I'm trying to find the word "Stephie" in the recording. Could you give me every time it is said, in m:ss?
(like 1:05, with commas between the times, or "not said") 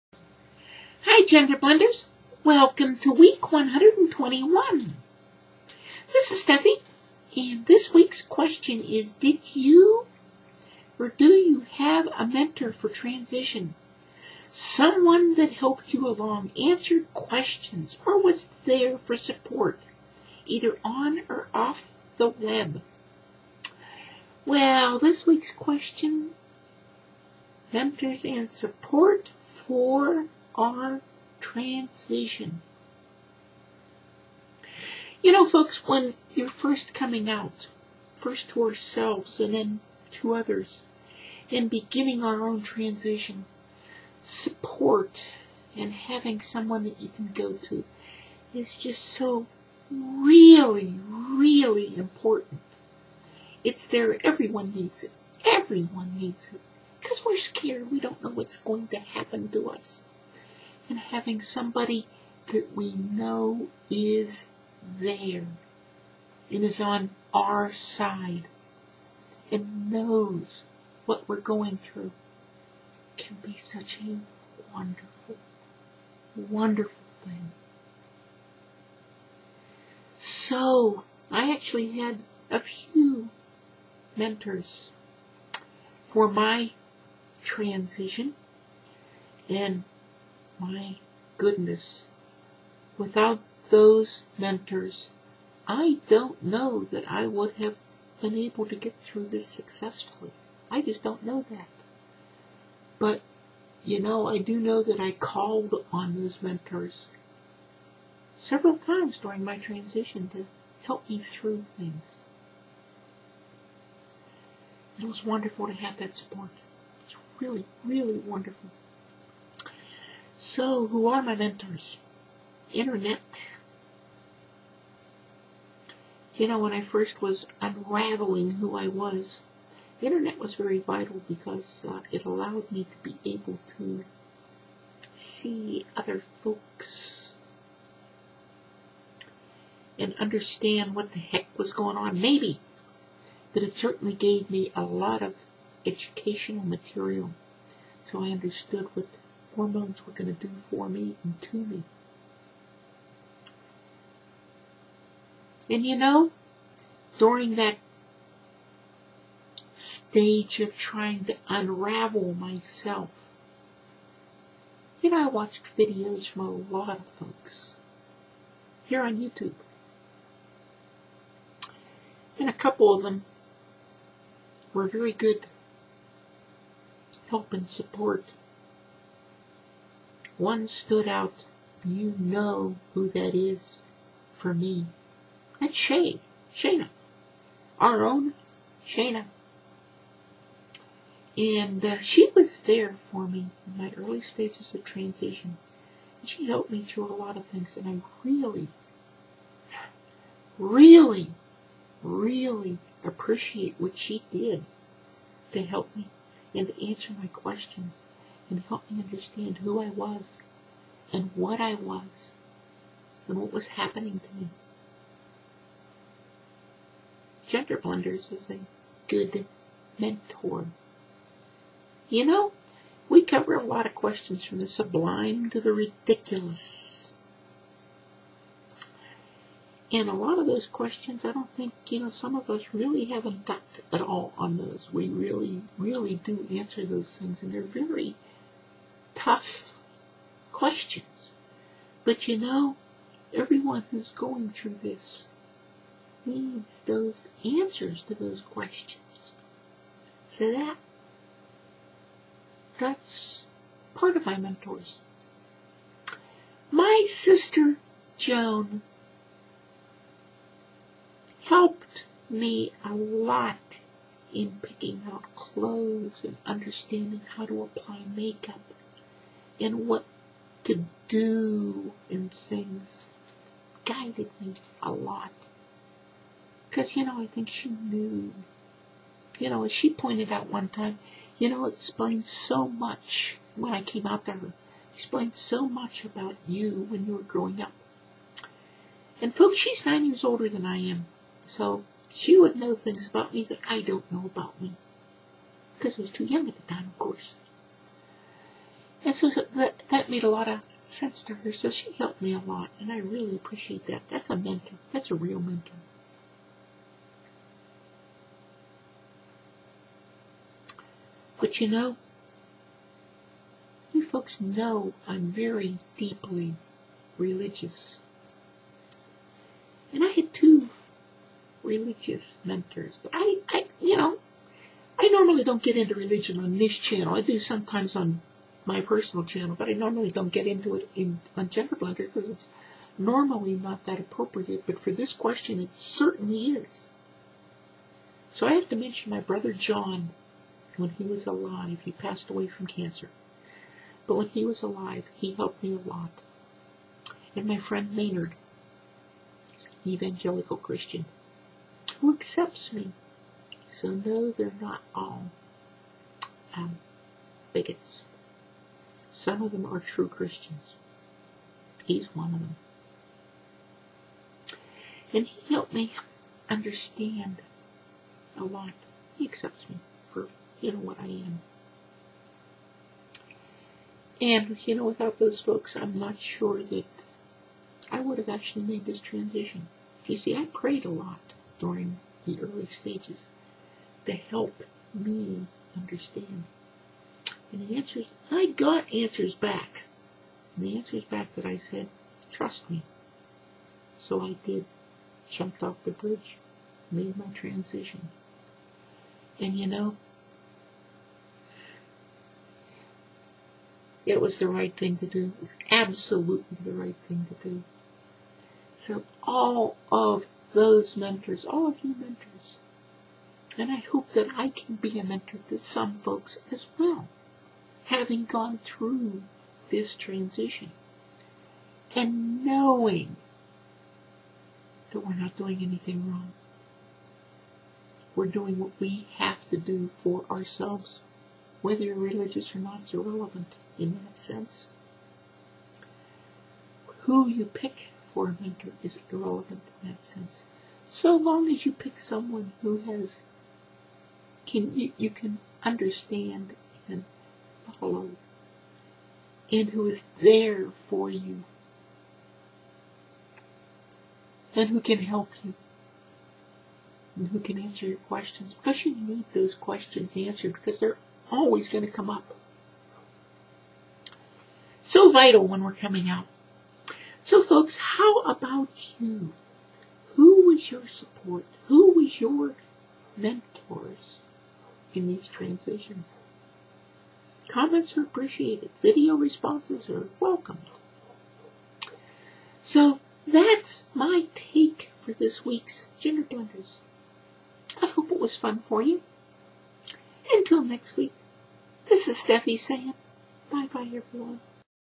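0:06, 8:12.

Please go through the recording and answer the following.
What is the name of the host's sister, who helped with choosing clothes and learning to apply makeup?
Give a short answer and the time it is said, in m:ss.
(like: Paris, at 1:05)
Joan, at 4:18.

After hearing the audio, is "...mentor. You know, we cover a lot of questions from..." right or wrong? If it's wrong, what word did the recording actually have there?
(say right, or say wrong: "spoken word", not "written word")
right.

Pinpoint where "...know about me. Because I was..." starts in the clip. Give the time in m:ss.
4:54.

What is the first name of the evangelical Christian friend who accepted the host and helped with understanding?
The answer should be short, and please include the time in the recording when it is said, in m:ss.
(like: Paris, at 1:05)
Maynard, at 5:47.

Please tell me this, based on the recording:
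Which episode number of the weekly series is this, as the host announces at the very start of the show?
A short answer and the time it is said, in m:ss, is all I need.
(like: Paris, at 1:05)
121, at 0:03.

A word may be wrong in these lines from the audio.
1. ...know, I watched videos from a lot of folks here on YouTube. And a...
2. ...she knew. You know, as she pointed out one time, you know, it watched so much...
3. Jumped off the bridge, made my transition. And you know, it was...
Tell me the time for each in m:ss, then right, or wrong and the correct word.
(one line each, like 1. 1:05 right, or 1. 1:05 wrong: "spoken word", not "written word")
1. 2:45 right
2. 4:37 wrong: "explained", not "watched"
3. 6:35 right.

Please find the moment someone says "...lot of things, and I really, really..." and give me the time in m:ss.
3:17.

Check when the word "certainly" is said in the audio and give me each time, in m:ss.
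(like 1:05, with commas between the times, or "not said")
2:23, 5:35.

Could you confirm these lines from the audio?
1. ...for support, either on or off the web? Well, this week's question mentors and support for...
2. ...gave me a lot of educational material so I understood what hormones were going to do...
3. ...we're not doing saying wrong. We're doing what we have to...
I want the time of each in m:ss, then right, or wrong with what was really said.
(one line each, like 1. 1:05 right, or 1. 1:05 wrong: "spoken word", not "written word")
1. 0:18 right
2. 2:24 right
3. 7:05 wrong: "anything", not "saying".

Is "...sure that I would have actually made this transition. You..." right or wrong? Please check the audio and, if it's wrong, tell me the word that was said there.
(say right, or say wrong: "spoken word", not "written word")
right.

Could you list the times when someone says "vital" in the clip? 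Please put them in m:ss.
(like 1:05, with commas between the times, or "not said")
2:10, 7:45.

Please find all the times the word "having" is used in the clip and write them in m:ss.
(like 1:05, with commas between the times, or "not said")
0:45, 1:00, 6:57.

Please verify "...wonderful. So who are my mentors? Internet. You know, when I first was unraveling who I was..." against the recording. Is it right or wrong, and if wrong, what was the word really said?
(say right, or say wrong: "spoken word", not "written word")
right.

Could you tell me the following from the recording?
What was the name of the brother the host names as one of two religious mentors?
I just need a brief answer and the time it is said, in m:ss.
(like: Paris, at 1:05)
John, at 5:39.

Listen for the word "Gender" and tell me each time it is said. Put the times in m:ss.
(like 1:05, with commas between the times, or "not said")
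0:01, 3:37, 5:31, 8:05.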